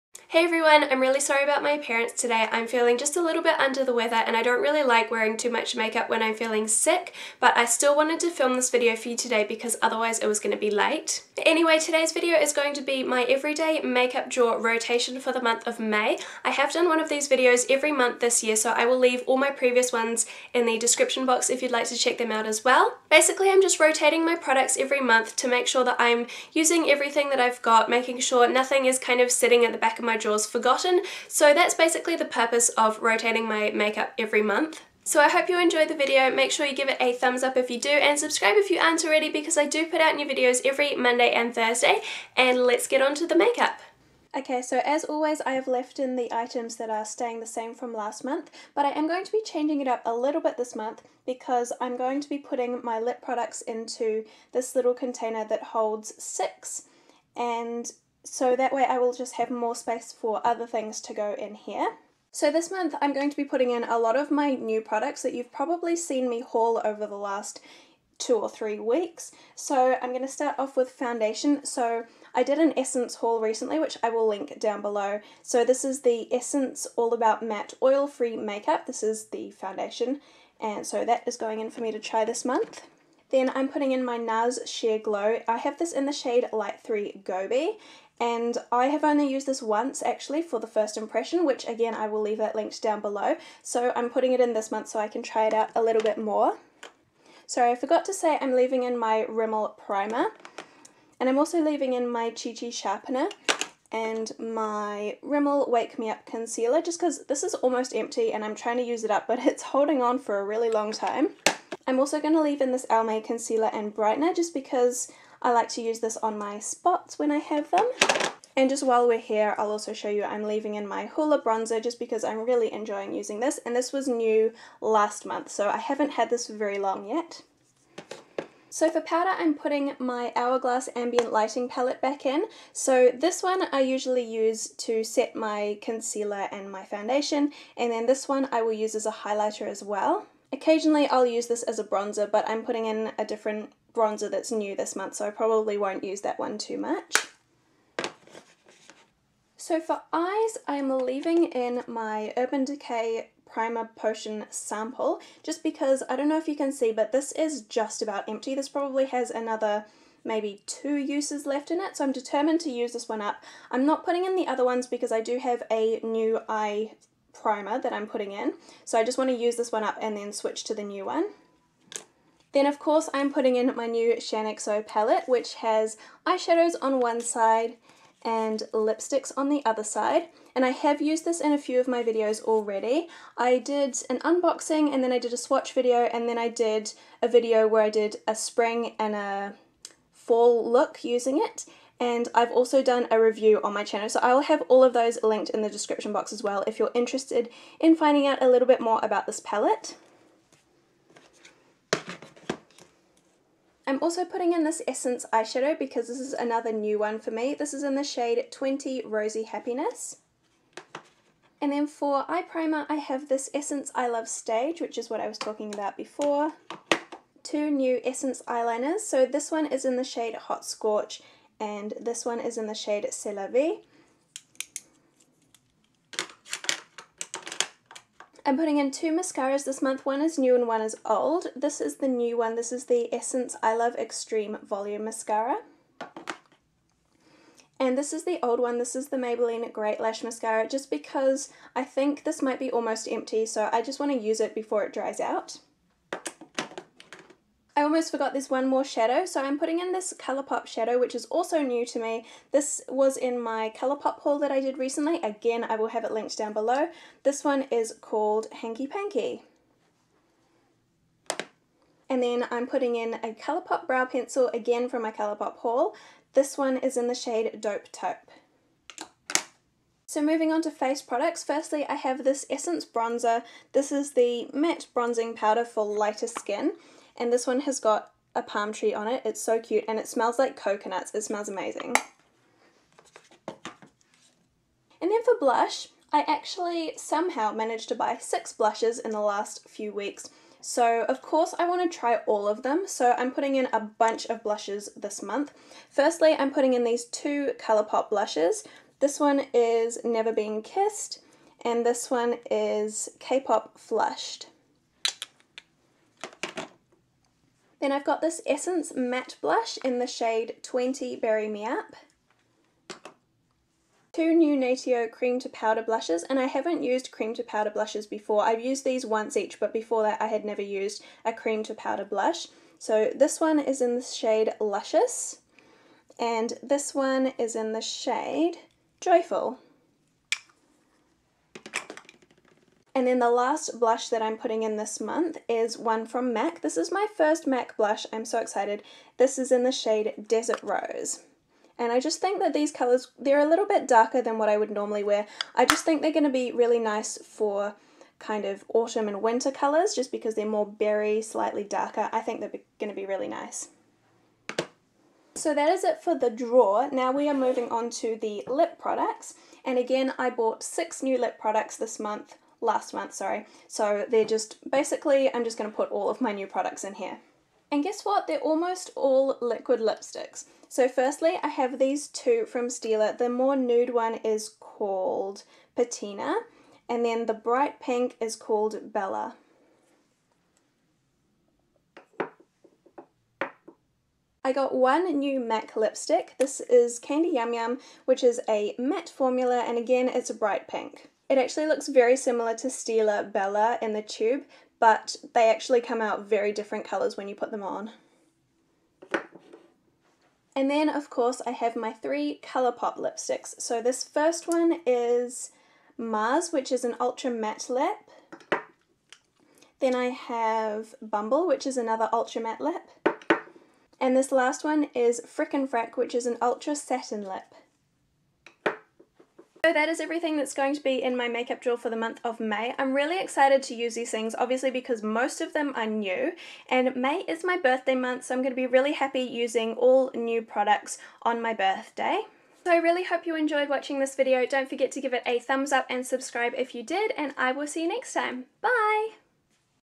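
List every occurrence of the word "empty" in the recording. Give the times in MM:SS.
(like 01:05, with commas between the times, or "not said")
01:47, 02:38, 04:03.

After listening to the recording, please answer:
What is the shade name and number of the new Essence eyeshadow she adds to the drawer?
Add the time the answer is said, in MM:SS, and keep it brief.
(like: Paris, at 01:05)
20 Rosy Happiness, at 03:28.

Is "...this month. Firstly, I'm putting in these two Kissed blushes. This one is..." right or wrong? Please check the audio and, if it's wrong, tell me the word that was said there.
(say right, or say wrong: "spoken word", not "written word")
wrong: "Colourpop", not "Kissed".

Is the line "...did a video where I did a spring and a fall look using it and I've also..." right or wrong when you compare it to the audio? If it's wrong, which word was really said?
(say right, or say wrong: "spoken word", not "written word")
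right.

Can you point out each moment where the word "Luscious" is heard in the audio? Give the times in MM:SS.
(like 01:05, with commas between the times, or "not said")
05:24.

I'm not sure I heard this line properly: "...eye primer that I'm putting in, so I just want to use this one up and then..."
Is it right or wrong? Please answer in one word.
right.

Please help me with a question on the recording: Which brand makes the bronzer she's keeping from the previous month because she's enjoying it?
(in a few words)
Hoola.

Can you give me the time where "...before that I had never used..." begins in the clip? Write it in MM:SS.
05:19.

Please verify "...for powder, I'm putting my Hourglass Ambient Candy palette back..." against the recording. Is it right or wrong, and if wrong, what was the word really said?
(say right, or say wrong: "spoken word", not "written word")
wrong: "Lighting", not "Candy".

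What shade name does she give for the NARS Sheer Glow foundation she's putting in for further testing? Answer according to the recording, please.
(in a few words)
Light 3 Gobi.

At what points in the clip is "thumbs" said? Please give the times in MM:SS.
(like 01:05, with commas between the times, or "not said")
00:37, 07:15.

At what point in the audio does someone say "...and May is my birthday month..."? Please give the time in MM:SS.
07:06.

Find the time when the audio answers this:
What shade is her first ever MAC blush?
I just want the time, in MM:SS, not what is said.
05:40.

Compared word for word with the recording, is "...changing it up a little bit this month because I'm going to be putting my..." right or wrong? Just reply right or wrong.
right.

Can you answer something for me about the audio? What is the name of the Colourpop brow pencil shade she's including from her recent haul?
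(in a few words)
Dope Taupe.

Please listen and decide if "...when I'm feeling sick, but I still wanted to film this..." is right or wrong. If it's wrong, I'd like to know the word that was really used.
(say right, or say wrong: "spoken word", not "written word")
right.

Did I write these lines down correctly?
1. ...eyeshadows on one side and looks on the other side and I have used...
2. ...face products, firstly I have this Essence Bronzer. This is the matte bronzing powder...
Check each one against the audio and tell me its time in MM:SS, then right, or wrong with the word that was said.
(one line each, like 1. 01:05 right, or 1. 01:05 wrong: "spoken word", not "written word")
1. 02:56 wrong: "lipsticks", not "looks"
2. 04:30 right.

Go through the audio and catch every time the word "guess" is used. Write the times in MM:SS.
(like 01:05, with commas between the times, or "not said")
06:07.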